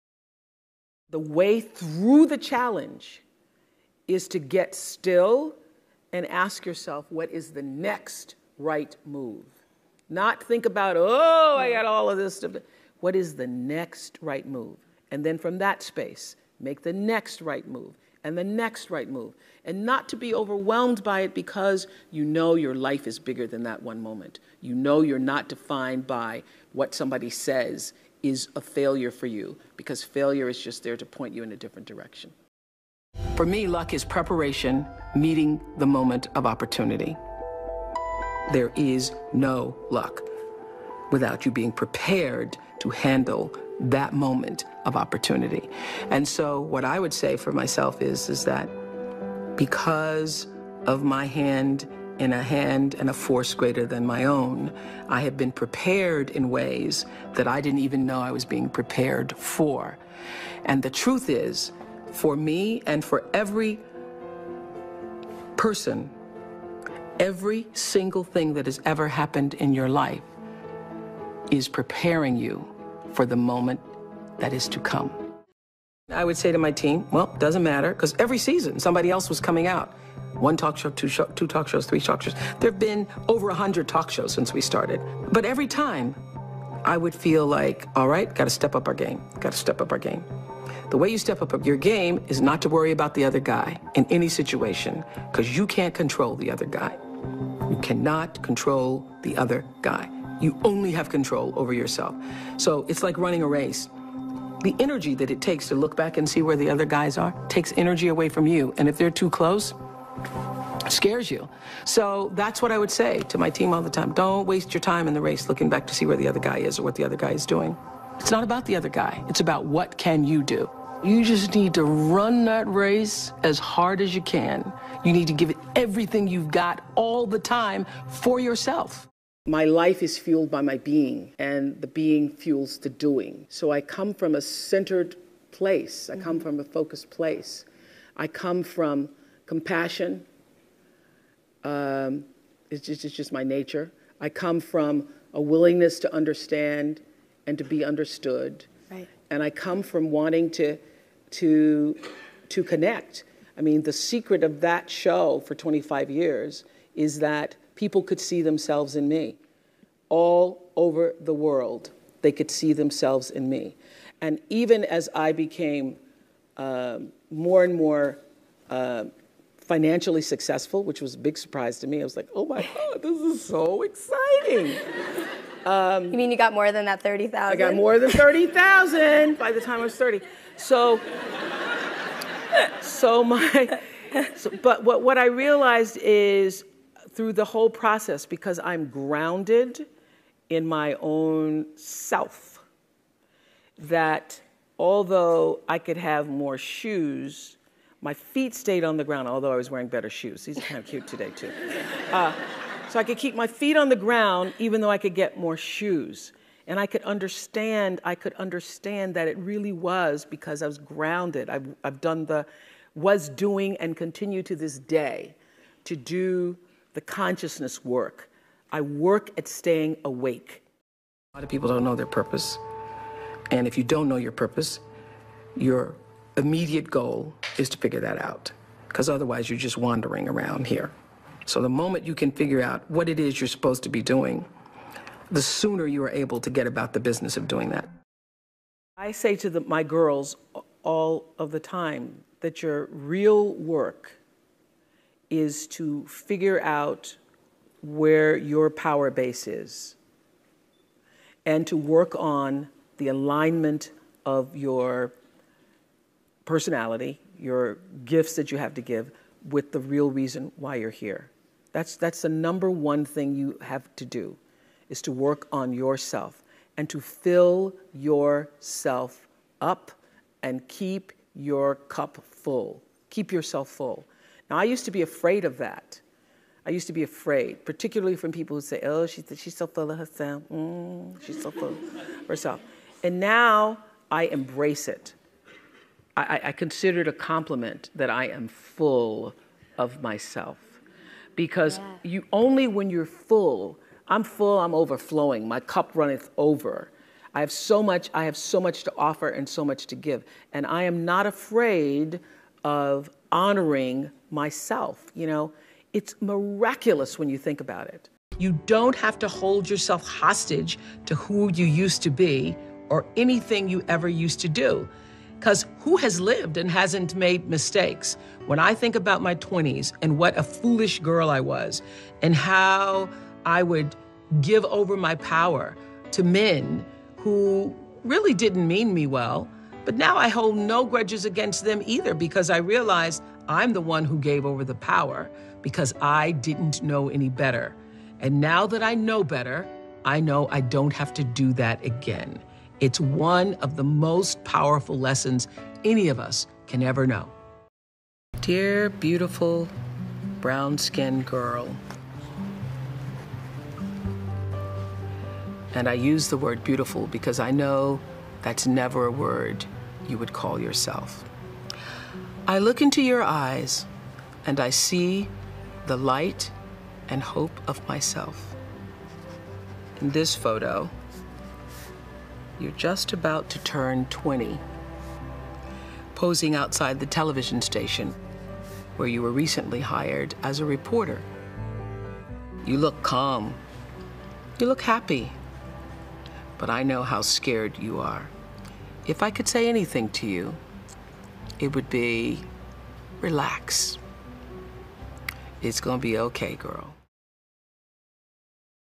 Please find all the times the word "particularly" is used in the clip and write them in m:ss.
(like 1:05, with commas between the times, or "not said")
4:37.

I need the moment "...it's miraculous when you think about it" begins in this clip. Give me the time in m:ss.
5:05.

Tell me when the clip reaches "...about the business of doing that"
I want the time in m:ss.
3:56.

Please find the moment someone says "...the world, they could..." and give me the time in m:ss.
2:41.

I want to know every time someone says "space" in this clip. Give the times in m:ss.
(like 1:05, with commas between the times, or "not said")
0:15.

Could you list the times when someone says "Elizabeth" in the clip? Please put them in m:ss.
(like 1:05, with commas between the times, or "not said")
not said.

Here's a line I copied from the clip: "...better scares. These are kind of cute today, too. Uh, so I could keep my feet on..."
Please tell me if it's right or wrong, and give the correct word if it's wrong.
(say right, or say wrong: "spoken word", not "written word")
wrong: "shoes", not "scares".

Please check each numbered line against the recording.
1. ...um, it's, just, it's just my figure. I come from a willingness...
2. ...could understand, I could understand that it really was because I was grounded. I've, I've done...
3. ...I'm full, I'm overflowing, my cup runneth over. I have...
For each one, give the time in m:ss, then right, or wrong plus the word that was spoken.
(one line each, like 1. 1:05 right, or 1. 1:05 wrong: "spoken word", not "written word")
1. 2:21 wrong: "nature", not "figure"
2. 3:26 right
3. 4:54 right.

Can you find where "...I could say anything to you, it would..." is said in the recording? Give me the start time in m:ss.
6:29.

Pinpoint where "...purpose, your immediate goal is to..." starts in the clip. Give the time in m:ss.
3:44.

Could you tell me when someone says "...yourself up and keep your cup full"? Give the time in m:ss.
4:27.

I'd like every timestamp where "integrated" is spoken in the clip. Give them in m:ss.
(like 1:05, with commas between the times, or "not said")
not said.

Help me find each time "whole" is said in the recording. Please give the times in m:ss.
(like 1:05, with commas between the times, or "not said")
3:07.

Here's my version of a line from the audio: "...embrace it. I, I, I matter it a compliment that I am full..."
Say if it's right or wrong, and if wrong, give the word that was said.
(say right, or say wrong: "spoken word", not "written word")
wrong: "consider", not "matter".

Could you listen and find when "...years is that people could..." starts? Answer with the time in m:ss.
2:36.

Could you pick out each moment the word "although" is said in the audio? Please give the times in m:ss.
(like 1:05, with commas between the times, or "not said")
3:14, 3:19.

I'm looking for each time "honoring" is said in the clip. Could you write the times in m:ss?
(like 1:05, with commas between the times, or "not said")
5:03.